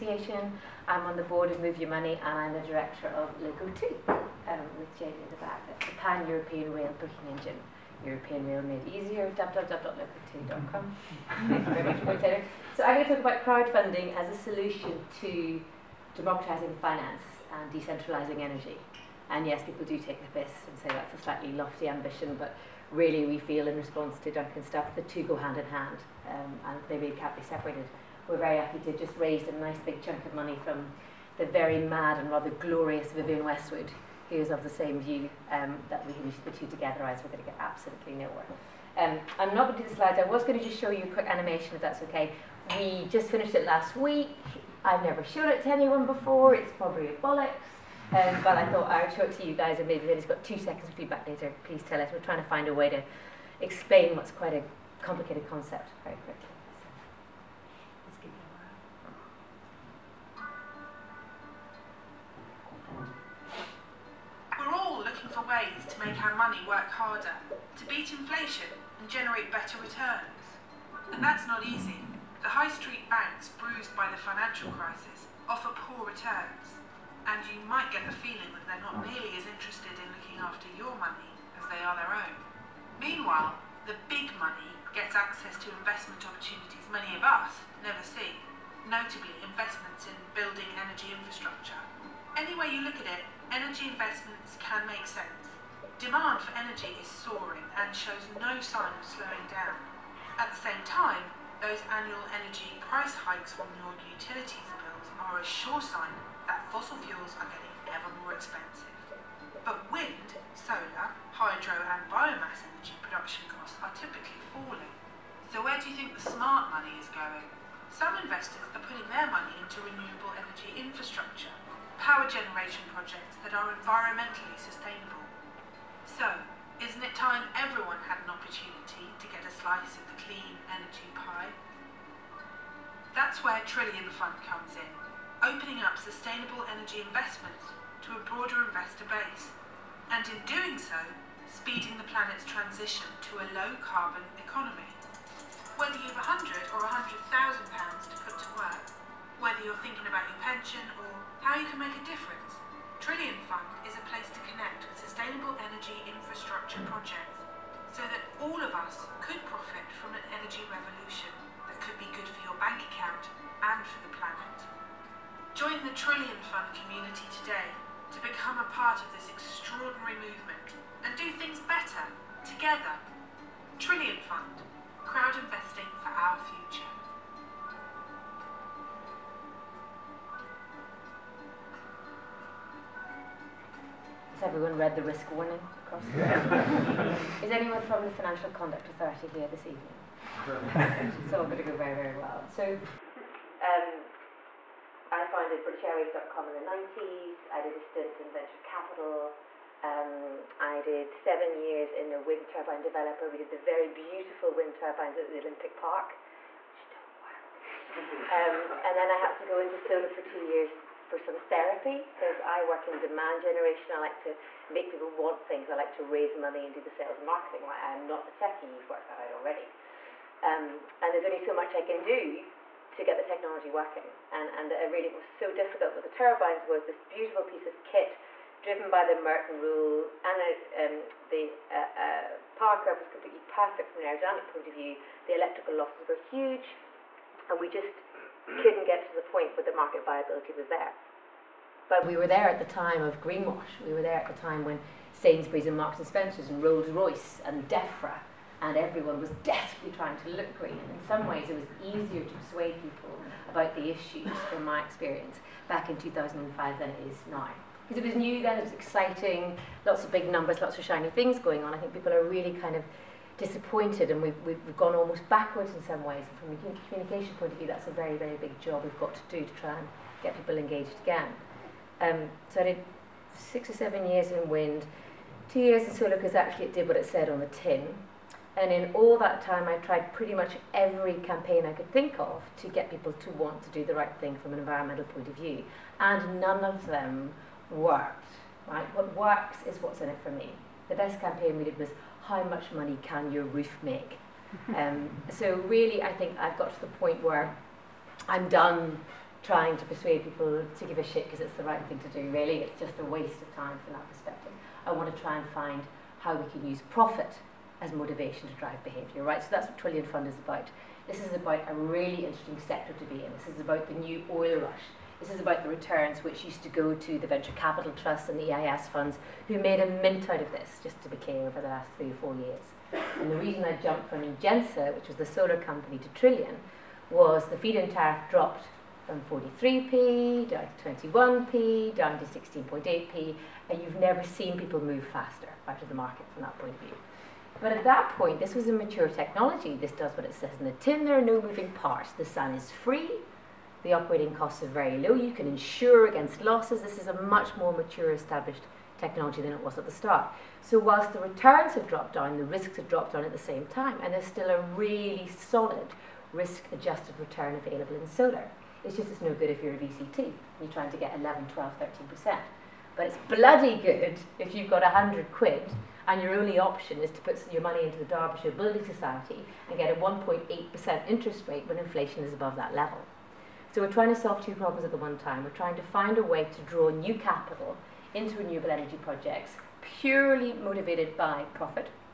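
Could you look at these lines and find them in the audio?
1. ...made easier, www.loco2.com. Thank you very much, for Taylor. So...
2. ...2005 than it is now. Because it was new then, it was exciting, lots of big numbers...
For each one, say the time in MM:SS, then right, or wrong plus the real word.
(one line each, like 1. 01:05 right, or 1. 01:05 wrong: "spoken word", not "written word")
1. 00:08 right
2. 04:15 right.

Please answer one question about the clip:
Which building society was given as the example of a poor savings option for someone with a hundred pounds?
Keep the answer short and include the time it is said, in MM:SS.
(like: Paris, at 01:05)
Derbyshire Building Society, at 06:08.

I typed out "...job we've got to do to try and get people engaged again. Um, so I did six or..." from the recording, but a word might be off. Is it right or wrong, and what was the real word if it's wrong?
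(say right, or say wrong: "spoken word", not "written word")
right.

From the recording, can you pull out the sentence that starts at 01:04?
We're all looking for ways to make our money work harder, to beat inflation and generate better returns.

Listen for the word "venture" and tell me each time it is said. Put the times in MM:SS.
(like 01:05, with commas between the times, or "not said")
03:18, 05:17.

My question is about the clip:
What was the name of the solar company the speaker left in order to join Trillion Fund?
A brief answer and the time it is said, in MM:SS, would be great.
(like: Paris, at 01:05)
Engensa, at 05:24.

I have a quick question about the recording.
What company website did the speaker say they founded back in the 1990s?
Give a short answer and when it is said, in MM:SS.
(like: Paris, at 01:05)
BritishAirways.com, at 03:15.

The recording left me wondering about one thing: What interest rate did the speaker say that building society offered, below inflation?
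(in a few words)
1.8%.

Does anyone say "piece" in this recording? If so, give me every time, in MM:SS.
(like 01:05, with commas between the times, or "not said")
03:47.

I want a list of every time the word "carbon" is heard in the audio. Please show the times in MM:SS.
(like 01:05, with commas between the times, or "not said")
02:23.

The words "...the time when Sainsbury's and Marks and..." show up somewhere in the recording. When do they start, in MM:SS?
04:04.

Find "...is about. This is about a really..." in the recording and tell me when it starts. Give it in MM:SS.
05:10.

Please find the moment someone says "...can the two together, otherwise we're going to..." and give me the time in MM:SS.
00:36.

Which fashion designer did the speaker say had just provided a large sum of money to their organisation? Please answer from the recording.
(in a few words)
Vivian Westwood.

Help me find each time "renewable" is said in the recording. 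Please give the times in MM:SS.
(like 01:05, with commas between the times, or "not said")
01:59, 06:18.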